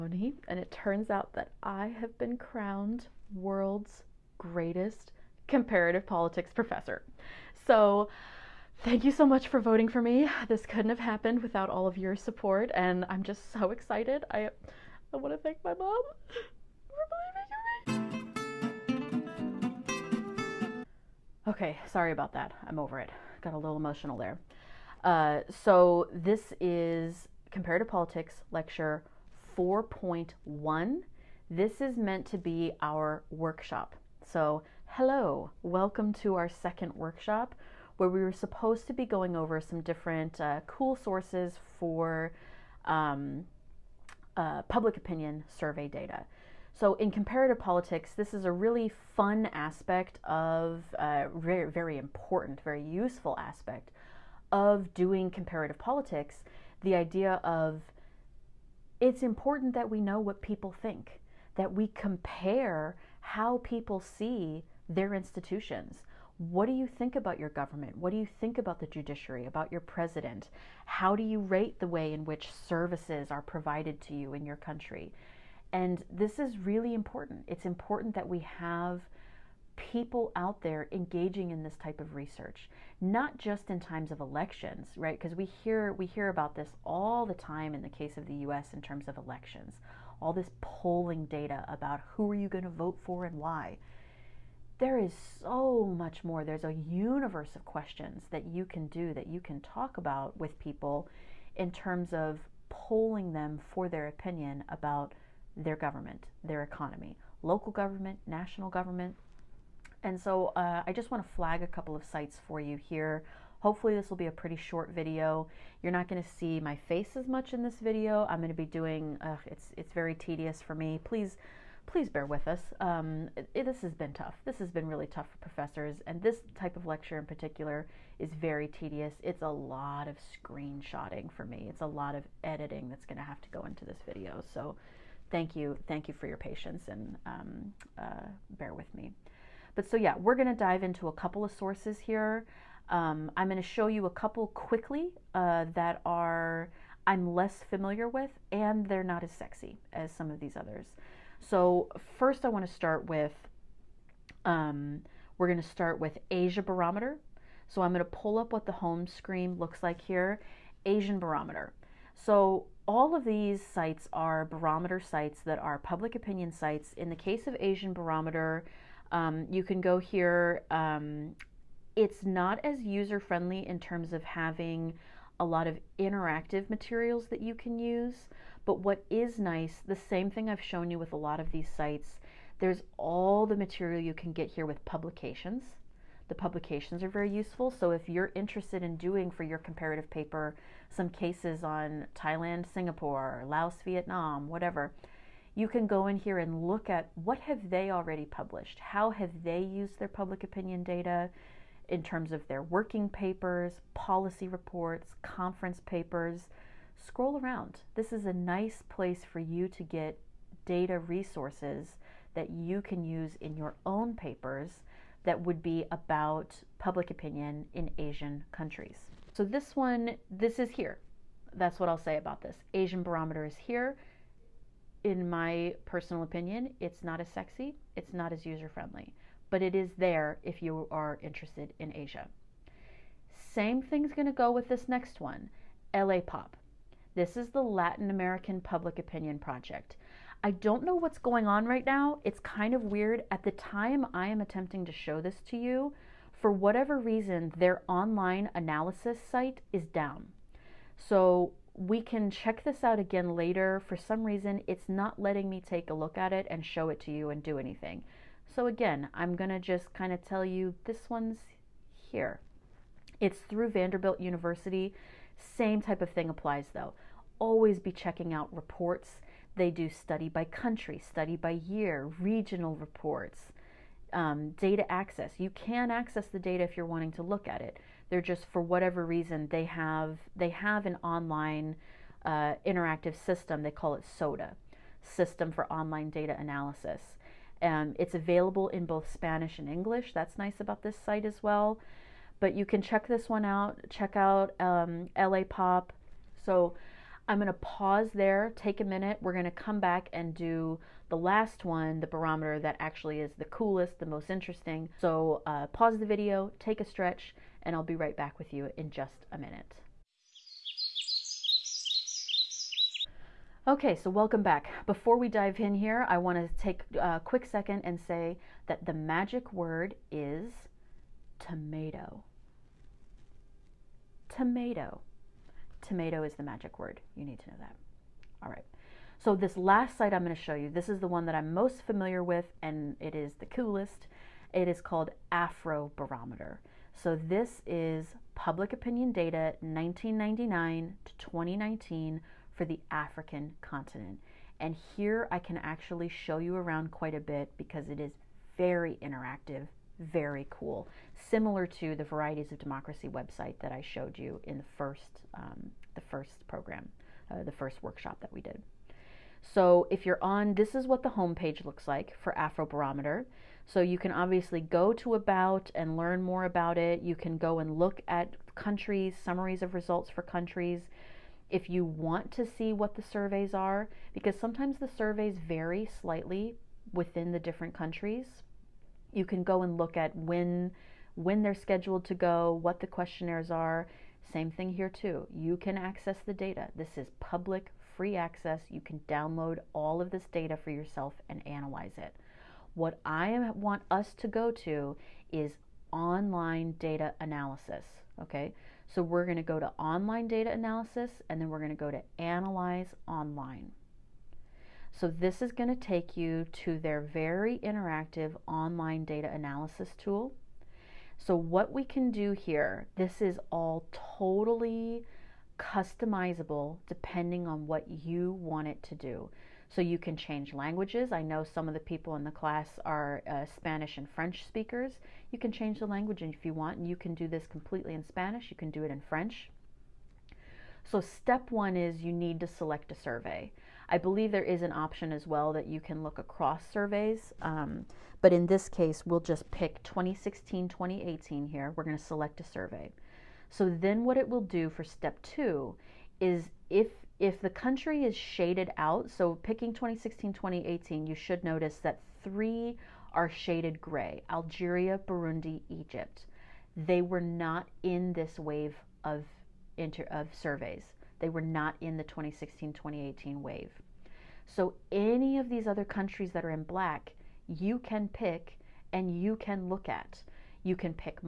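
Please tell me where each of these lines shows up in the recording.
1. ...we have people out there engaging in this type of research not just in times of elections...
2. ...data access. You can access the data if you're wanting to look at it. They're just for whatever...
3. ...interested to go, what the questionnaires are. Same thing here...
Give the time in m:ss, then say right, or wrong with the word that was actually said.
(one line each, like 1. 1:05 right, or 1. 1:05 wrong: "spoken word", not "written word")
1. 1:18 right
2. 4:34 right
3. 6:21 wrong: "scheduled", not "interested".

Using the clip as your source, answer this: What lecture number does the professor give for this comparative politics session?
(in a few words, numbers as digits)
4.1.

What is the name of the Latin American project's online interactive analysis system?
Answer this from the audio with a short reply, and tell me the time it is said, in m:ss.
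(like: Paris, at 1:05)
SODA, at 4:44.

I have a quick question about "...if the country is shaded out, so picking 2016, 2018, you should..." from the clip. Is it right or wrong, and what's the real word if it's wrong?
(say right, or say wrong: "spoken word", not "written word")
right.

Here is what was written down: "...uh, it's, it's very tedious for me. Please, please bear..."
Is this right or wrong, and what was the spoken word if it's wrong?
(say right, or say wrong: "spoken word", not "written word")
right.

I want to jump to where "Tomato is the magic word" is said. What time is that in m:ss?
5:25.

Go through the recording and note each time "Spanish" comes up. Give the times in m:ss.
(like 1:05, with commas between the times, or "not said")
4:49, 7:03, 7:08.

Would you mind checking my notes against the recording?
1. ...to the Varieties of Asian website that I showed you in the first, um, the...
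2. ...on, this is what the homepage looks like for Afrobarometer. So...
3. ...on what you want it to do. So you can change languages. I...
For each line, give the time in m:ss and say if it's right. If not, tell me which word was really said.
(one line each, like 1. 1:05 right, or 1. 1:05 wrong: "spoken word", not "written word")
1. 5:51 wrong: "Democracy", not "Asian"
2. 6:00 right
3. 6:57 right.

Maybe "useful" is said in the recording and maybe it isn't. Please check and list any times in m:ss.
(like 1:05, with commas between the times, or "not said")
0:52, 3:07.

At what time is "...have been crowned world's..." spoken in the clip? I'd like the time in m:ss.
0:01.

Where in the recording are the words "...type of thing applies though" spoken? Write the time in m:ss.
4:25.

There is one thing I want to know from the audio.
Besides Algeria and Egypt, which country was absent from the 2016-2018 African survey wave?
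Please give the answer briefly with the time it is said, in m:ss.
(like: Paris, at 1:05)
Burundi, at 7:35.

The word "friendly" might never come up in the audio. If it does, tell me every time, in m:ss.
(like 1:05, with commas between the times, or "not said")
2:53, 3:48.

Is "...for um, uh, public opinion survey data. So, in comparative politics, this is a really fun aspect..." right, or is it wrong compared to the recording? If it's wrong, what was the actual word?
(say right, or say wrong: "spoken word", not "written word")
right.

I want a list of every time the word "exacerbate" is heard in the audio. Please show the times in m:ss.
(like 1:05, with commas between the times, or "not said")
not said.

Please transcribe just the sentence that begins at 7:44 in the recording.
So, any of these other countries that are in black, you can pick and you can look at.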